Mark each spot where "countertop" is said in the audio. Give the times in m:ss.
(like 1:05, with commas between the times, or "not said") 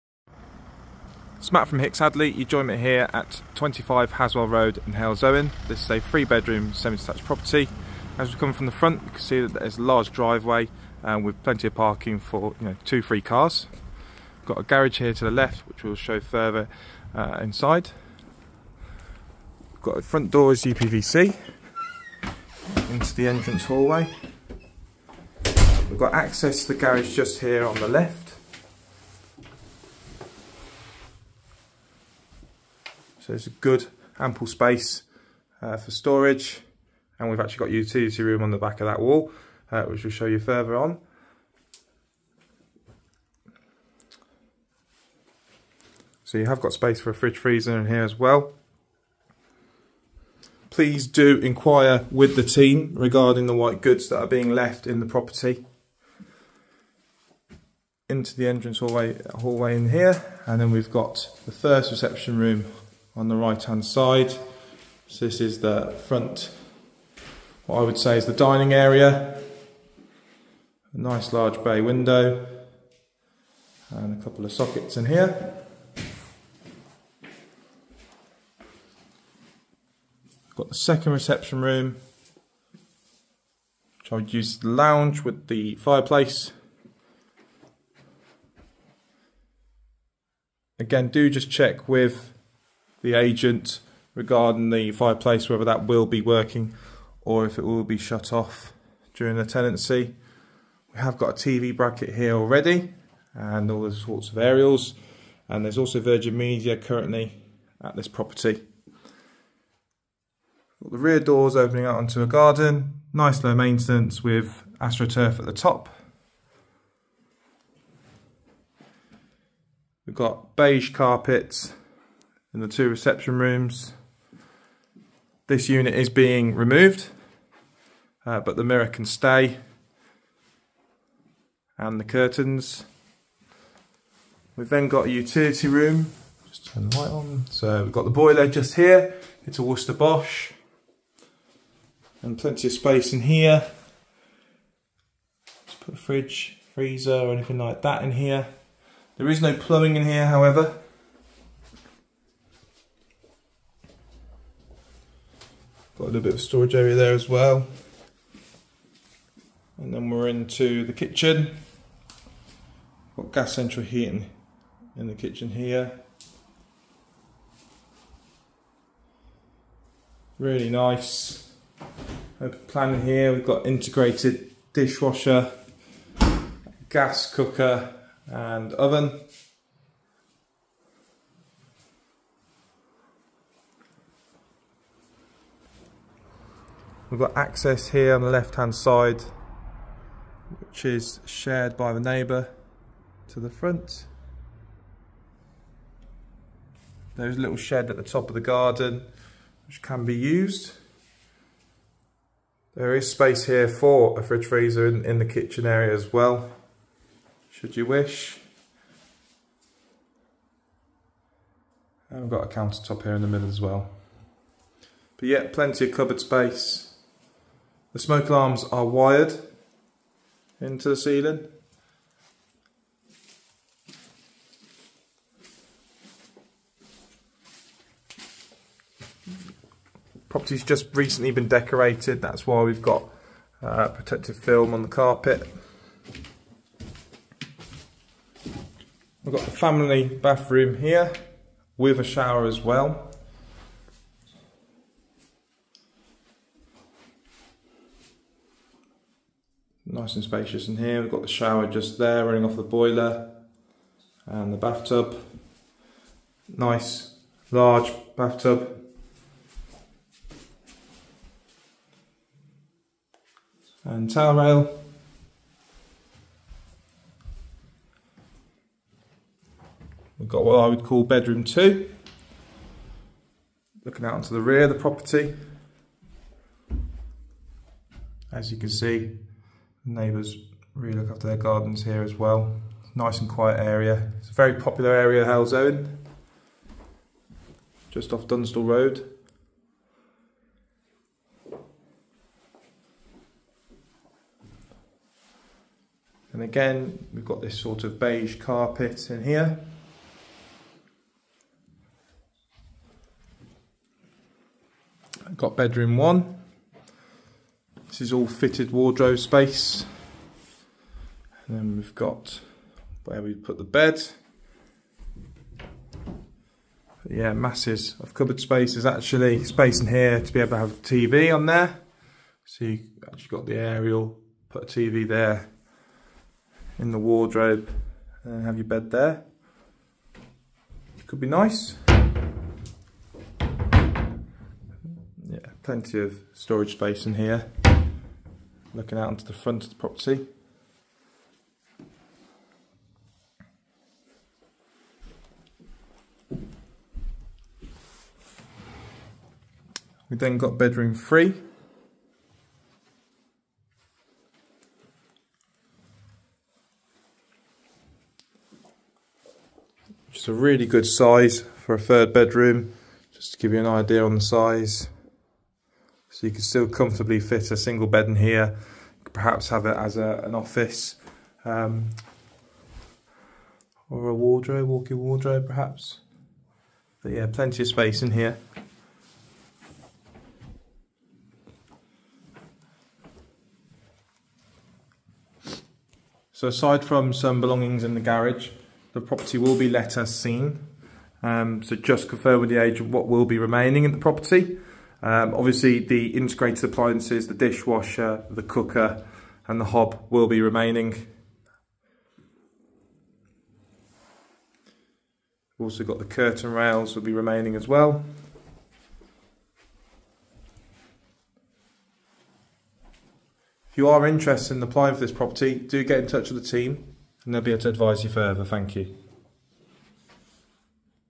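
3:32.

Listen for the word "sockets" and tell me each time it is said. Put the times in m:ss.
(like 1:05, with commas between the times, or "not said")
1:14.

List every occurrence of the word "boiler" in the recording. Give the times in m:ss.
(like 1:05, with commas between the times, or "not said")
2:18, 4:12.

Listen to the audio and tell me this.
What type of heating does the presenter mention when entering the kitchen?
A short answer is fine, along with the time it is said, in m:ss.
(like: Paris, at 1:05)
Gas central heating, at 2:43.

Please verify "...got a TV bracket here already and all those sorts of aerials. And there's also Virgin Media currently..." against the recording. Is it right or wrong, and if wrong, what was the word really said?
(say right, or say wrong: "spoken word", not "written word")
right.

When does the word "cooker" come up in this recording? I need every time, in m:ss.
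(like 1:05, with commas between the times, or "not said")
2:57, 6:38.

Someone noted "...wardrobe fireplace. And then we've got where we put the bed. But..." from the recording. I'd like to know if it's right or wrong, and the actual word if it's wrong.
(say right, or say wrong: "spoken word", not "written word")
wrong: "space", not "fireplace".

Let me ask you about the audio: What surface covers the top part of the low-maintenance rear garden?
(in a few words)
AstroTurf.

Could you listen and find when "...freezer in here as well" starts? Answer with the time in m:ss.
0:47.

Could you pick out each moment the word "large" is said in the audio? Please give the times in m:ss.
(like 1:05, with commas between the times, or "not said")
0:09, 1:11, 4:17.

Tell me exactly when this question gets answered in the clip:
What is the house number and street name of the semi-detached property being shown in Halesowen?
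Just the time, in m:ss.
0:03.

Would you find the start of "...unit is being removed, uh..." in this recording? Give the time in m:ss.
2:05.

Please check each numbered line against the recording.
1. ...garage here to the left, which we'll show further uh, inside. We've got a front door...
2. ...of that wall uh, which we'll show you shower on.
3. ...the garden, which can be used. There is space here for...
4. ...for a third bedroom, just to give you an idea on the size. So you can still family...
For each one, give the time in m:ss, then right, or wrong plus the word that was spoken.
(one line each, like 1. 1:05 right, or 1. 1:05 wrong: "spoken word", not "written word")
1. 0:14 right
2. 0:38 wrong: "further", not "shower"
3. 3:18 right
4. 6:01 wrong: "comfortably", not "family".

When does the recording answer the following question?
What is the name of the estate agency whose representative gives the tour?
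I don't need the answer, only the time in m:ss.
0:01.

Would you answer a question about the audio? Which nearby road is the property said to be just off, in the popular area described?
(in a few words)
Dunstall Road.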